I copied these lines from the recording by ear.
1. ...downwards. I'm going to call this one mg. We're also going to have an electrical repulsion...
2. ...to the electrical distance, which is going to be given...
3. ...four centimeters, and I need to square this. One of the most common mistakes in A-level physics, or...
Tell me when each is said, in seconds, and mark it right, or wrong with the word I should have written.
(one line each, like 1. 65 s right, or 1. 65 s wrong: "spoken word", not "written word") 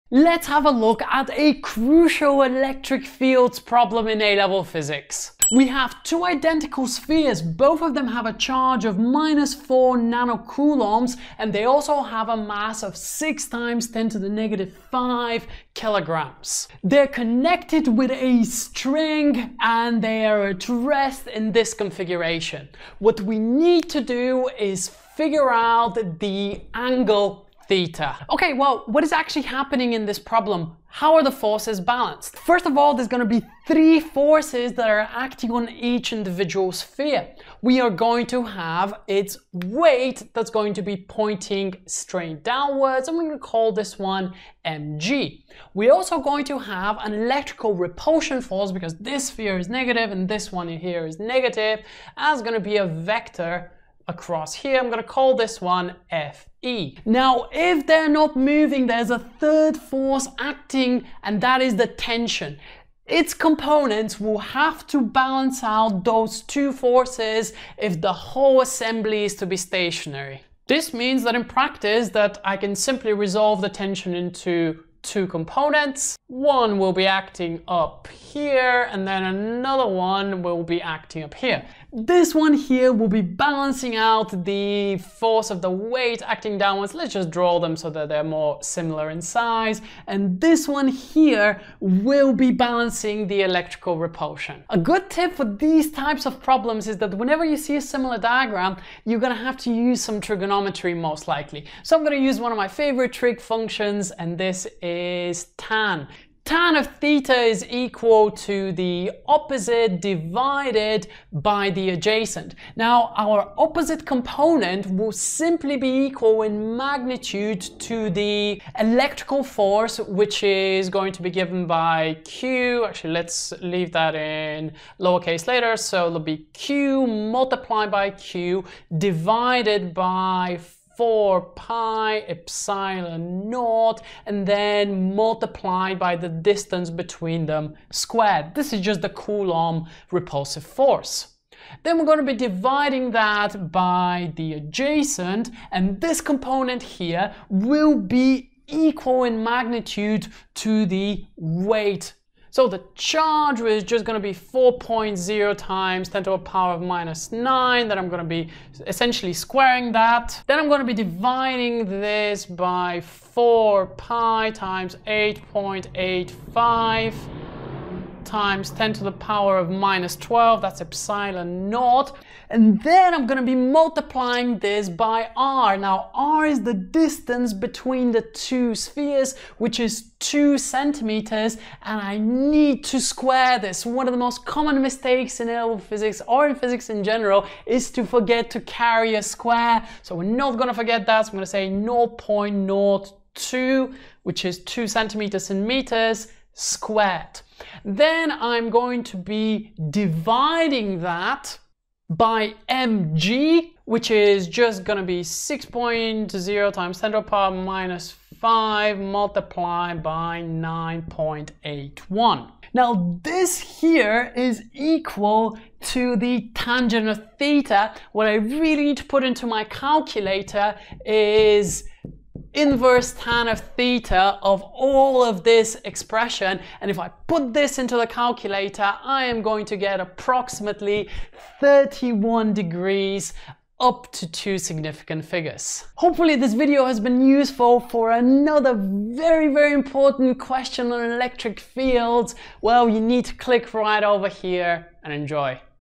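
1. 42 s right
2. 117 s wrong: "force", not "distance"
3. 180 s wrong: "two", not "four".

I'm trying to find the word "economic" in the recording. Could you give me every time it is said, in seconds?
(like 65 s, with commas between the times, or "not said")
not said.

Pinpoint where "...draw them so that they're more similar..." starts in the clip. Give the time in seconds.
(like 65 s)
87 s.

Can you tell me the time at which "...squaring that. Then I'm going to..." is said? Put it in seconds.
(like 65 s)
159 s.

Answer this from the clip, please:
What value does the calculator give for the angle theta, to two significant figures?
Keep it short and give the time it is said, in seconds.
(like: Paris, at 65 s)
31 degrees, at 231 s.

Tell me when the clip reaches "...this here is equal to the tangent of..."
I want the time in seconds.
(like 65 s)
213 s.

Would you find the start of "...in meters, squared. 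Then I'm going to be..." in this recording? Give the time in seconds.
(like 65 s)
195 s.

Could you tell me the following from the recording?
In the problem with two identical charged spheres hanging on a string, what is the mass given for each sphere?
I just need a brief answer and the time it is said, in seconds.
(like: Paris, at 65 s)
6 × 10^-5 kg, at 12 s.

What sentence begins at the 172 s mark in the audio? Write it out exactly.
And then I'm gonna be multiplying this by r.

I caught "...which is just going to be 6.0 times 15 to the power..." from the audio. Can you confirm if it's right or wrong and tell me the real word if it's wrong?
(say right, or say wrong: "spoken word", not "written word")
wrong: "10", not "15".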